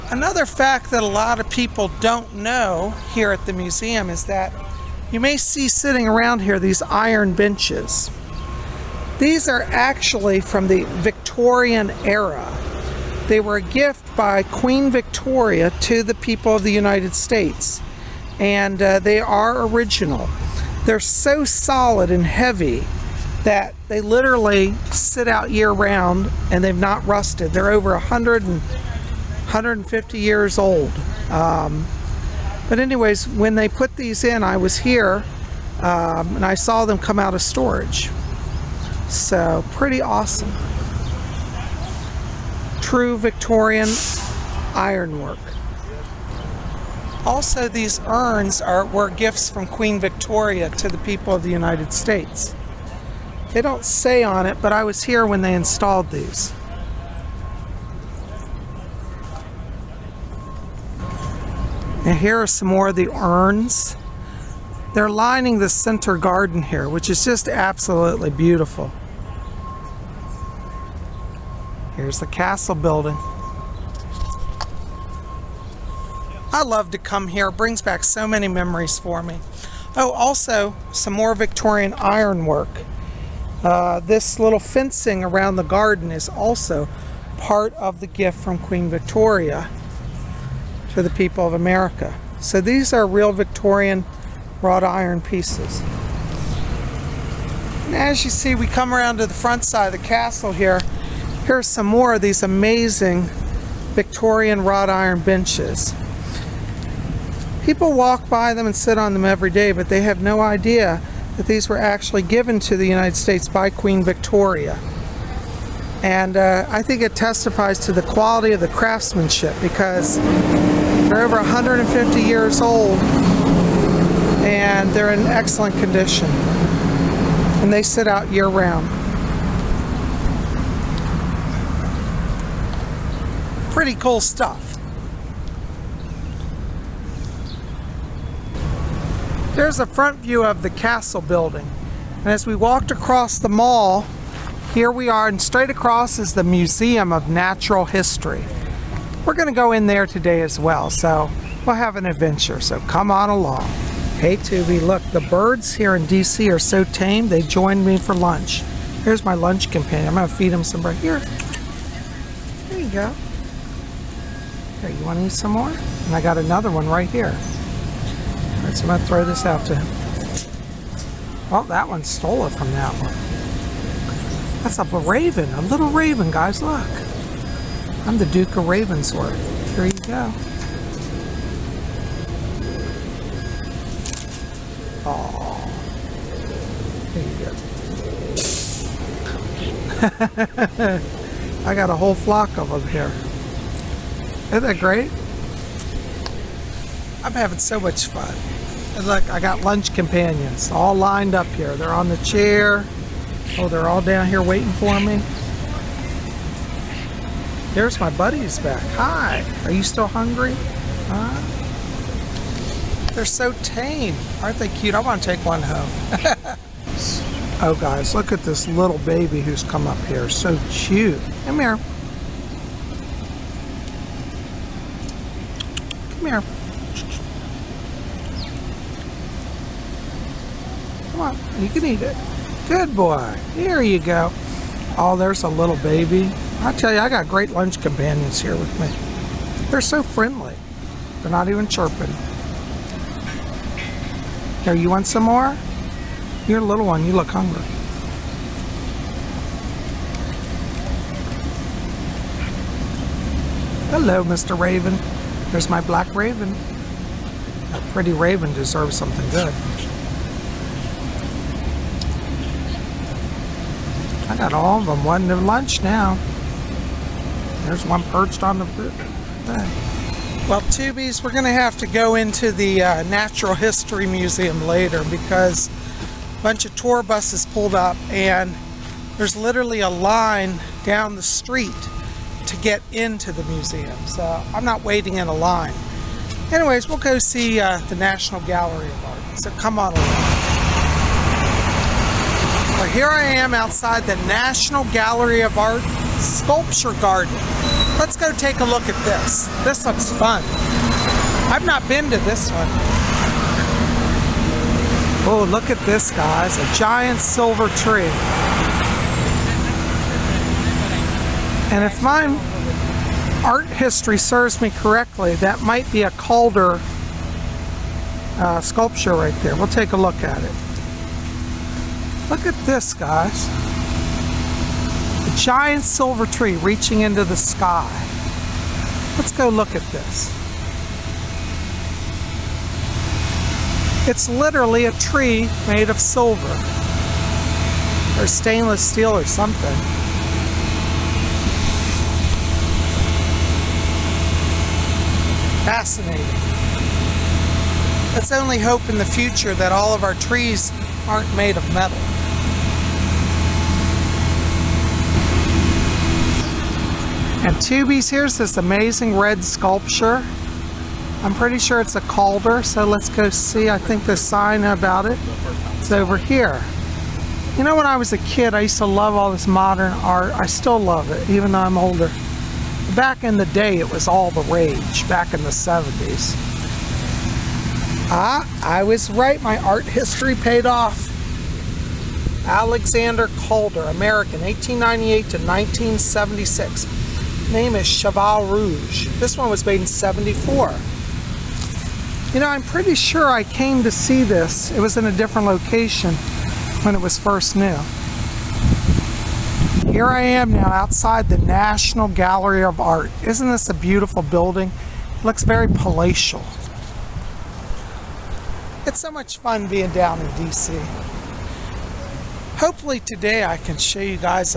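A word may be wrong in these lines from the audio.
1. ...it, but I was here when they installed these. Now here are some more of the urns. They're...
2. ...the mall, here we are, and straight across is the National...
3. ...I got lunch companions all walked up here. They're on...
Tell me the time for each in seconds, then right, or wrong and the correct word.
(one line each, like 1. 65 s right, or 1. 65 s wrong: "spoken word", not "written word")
1. 54 s right
2. 143 s wrong: "Museum", not "National"
3. 199 s wrong: "lined", not "walked".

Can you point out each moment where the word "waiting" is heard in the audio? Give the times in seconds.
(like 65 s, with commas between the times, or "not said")
204 s, 284 s.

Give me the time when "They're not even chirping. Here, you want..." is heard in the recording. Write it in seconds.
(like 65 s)
241 s.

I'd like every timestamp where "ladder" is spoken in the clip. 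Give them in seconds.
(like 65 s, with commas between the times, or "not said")
not said.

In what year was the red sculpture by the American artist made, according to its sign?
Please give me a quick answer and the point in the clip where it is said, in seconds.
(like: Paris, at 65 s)
1974, at 389 s.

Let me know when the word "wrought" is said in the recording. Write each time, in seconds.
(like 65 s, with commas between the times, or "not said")
94 s, 104 s.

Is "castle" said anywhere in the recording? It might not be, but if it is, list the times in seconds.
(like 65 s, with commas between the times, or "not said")
72 s, 100 s, 140 s.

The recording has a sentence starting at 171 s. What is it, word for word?
Well, that one stole it from that one.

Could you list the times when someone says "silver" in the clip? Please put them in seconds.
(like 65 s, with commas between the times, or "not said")
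307 s, 325 s, 335 s.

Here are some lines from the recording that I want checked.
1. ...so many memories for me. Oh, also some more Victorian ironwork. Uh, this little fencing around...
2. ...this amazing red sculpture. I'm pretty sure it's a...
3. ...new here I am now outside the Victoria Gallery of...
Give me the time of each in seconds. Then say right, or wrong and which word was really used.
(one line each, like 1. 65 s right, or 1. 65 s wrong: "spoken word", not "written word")
1. 78 s right
2. 358 s right
3. 397 s wrong: "National", not "Victoria".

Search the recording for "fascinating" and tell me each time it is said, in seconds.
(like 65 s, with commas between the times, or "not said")
345 s.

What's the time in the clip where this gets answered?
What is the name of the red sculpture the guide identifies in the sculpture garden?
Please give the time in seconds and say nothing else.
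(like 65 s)
387 s.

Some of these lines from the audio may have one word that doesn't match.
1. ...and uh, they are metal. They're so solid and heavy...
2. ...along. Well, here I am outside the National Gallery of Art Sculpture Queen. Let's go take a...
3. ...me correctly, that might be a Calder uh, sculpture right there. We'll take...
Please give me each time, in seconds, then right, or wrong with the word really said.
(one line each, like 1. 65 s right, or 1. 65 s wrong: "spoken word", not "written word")
1. 18 s wrong: "original", not "metal"
2. 289 s wrong: "Garden", not "Queen"
3. 314 s right.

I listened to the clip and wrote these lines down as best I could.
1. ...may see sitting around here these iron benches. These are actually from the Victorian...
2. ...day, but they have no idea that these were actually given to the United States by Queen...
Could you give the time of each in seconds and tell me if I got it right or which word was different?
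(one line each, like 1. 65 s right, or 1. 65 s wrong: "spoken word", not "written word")
1. 5 s right
2. 109 s right.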